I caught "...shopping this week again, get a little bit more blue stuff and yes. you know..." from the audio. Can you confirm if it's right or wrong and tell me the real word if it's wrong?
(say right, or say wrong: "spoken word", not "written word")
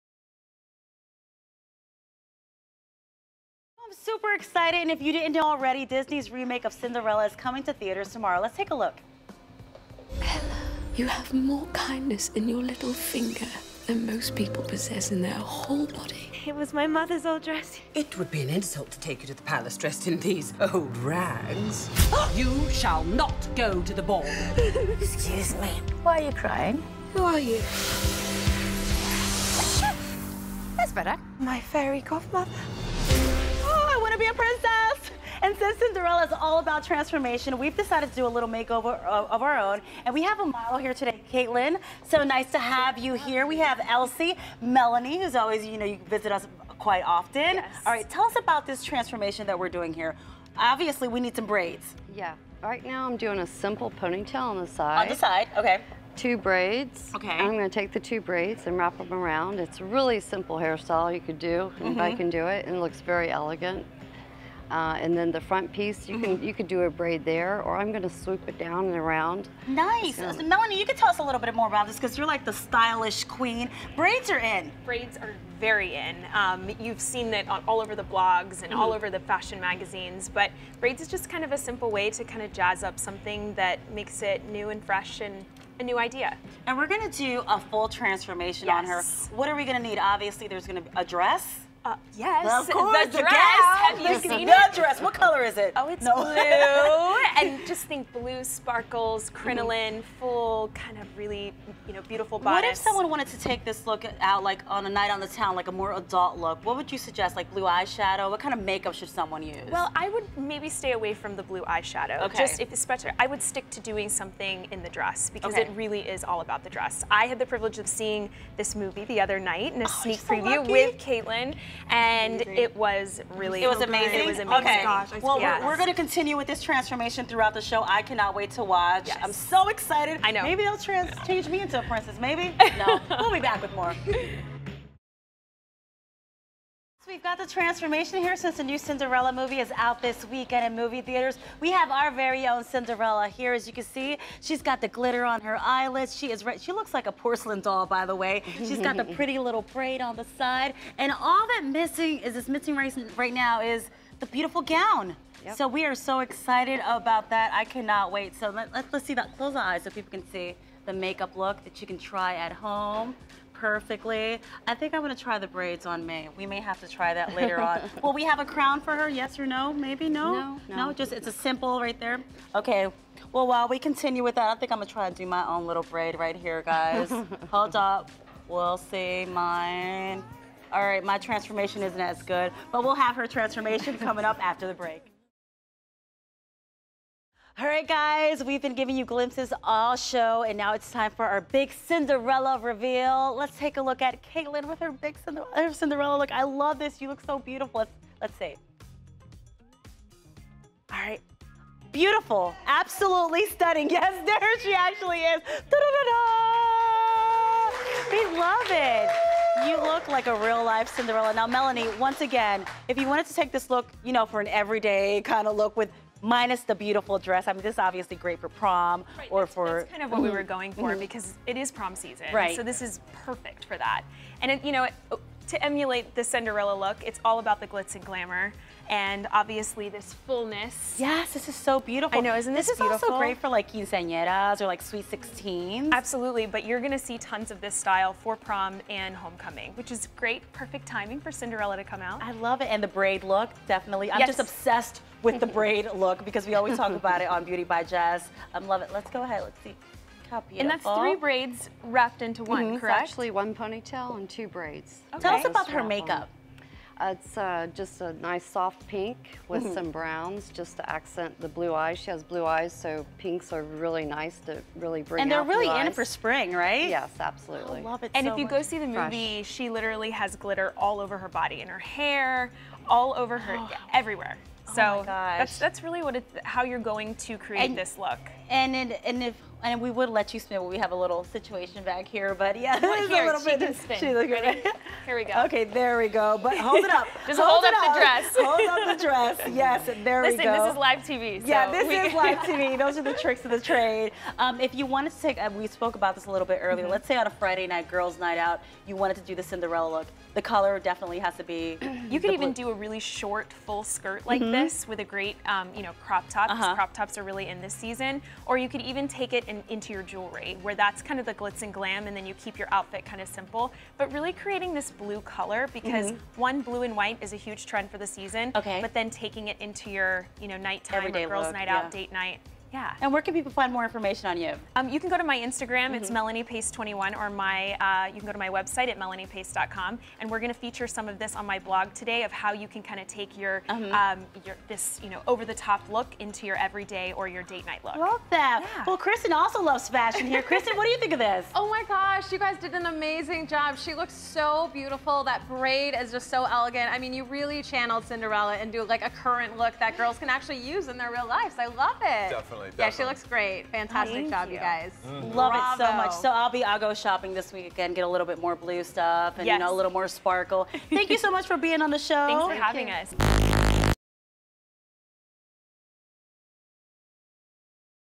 right.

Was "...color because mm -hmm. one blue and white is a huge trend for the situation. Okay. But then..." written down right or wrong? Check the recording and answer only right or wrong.
wrong.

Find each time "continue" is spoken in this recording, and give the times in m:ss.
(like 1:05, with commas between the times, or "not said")
2:06, 2:53.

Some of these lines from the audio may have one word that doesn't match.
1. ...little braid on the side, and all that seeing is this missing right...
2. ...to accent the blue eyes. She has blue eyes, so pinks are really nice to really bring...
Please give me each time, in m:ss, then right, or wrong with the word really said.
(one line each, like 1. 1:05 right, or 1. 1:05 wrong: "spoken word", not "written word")
1. 2:29 wrong: "missing", not "seeing"
2. 4:20 right.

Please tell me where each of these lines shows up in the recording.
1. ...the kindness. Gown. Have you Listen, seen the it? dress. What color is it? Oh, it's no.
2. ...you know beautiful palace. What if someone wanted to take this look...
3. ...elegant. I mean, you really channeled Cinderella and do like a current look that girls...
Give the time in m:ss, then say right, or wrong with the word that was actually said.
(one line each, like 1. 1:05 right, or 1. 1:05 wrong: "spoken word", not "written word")
1. 1:33 wrong: "dress", not "kindness"
2. 1:41 wrong: "bodice", not "palace"
3. 5:46 right.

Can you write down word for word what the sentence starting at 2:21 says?
We have our very own Cinderella here, as you can see.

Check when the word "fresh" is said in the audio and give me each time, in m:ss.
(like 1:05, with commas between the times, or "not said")
1:24, 4:29.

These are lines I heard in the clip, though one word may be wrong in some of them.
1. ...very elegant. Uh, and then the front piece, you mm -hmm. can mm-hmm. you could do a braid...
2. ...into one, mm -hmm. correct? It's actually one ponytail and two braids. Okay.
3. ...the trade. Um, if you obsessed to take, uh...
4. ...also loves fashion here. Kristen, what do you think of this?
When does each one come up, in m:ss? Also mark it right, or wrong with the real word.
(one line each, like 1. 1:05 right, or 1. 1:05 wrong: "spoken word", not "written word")
1. 1:03 right
2. 4:12 right
3. 4:53 wrong: "wanted", not "obsessed"
4. 5:39 right.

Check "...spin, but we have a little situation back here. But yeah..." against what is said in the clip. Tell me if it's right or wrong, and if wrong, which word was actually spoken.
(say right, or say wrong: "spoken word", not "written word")
right.